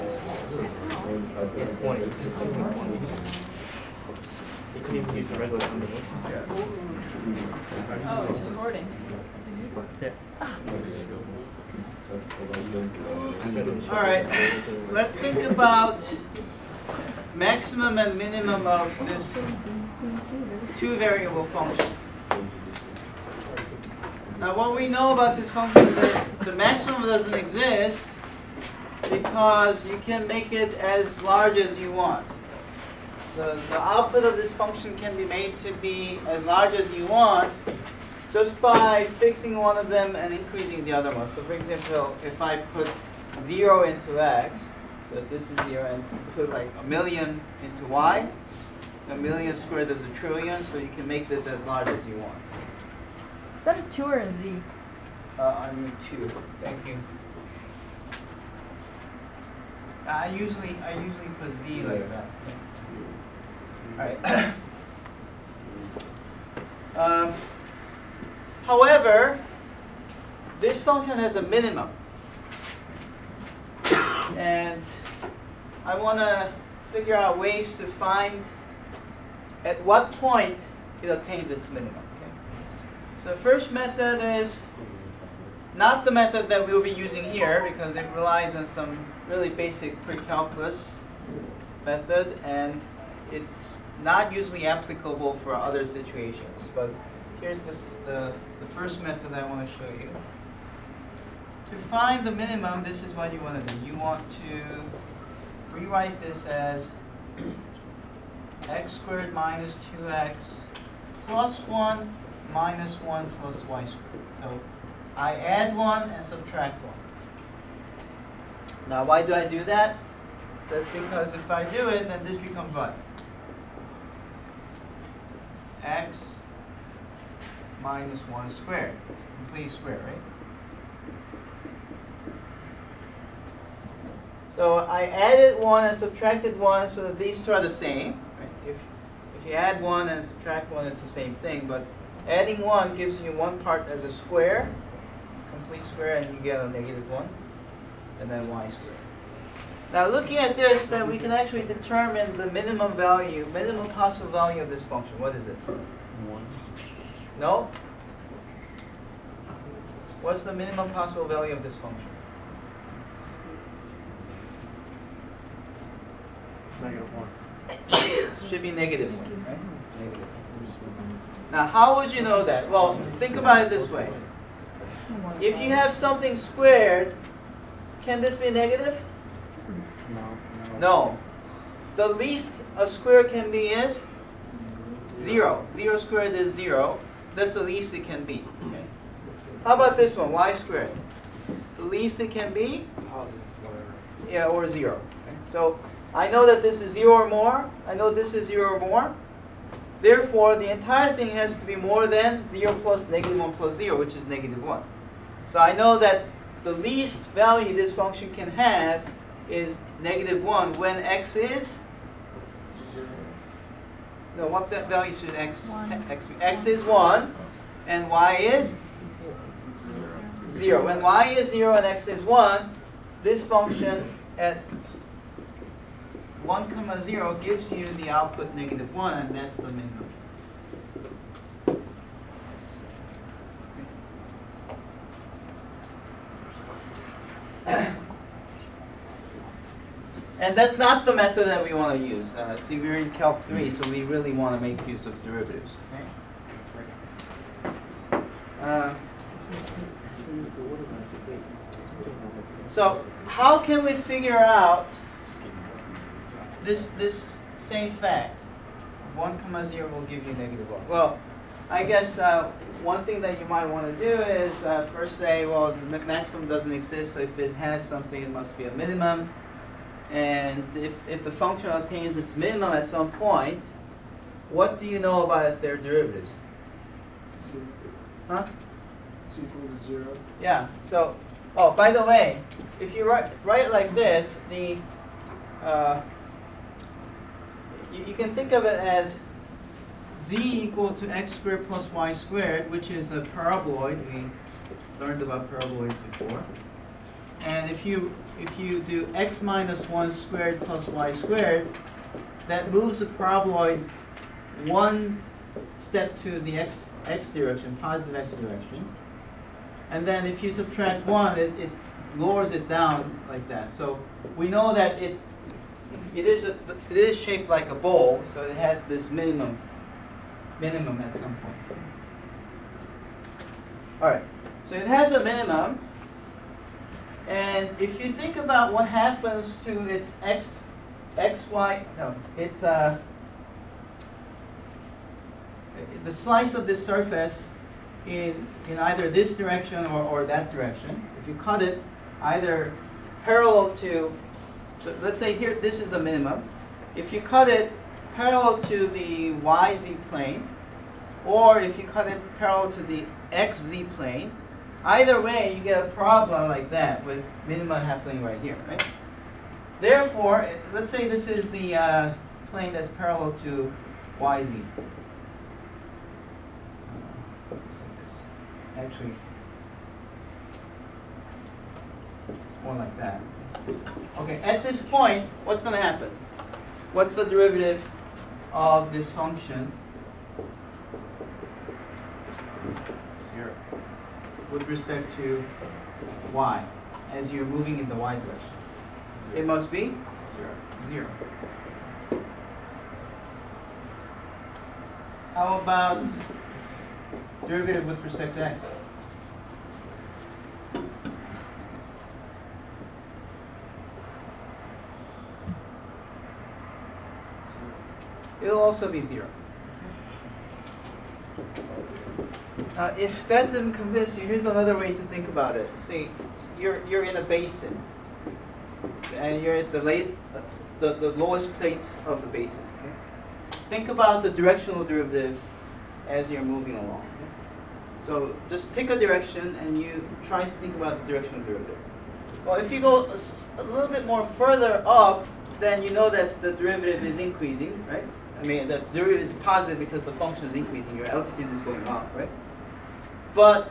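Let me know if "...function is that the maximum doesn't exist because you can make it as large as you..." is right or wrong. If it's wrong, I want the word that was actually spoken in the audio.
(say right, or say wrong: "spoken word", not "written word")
right.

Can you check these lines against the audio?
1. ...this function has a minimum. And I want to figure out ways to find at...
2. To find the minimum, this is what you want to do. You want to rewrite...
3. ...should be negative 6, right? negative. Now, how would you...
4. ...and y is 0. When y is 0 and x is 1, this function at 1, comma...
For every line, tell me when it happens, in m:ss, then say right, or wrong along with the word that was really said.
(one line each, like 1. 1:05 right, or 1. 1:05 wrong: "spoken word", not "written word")
1. 1:10 right
2. 1:41 right
3. 2:48 wrong: "1", not "6"
4. 3:37 right.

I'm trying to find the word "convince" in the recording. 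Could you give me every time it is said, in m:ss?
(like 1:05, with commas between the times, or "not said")
6:53.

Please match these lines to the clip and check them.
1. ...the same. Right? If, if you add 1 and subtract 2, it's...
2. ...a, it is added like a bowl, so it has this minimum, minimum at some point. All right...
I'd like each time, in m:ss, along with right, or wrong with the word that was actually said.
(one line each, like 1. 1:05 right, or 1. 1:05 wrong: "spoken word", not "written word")
1. 2:17 wrong: "1", not "2"
2. 5:16 wrong: "shaped", not "added".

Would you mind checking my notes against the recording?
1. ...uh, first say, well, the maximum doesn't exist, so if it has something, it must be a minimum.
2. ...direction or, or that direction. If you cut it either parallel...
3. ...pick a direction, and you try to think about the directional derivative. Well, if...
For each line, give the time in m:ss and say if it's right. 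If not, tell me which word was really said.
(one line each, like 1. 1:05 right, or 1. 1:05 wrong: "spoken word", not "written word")
1. 4:24 right
2. 5:39 right
3. 7:08 right.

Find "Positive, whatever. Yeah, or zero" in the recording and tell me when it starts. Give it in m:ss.
3:13.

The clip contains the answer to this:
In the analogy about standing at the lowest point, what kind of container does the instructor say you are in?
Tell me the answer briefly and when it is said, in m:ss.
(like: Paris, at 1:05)
a basin, at 6:57.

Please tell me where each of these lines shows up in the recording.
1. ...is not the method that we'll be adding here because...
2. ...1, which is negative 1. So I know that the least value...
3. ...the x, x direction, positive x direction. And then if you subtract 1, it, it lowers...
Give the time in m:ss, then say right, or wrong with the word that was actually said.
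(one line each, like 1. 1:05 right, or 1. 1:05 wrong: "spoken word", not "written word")
1. 1:24 wrong: "using", not "adding"
2. 3:23 wrong: "0", not "1"
3. 5:06 right.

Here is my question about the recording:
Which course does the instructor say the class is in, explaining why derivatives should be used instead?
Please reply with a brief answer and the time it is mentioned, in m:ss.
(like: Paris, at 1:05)
Calc 3, at 4:03.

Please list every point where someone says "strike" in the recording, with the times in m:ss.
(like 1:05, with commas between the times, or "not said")
not said.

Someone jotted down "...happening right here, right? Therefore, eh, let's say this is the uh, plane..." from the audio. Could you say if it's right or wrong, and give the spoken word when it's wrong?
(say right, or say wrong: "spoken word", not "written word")
right.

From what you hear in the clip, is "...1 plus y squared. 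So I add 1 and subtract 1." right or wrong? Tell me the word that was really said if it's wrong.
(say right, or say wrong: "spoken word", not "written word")
right.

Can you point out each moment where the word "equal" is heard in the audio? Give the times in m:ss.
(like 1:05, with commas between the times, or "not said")
4:39, 4:50.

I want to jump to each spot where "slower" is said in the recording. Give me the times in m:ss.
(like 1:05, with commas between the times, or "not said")
not said.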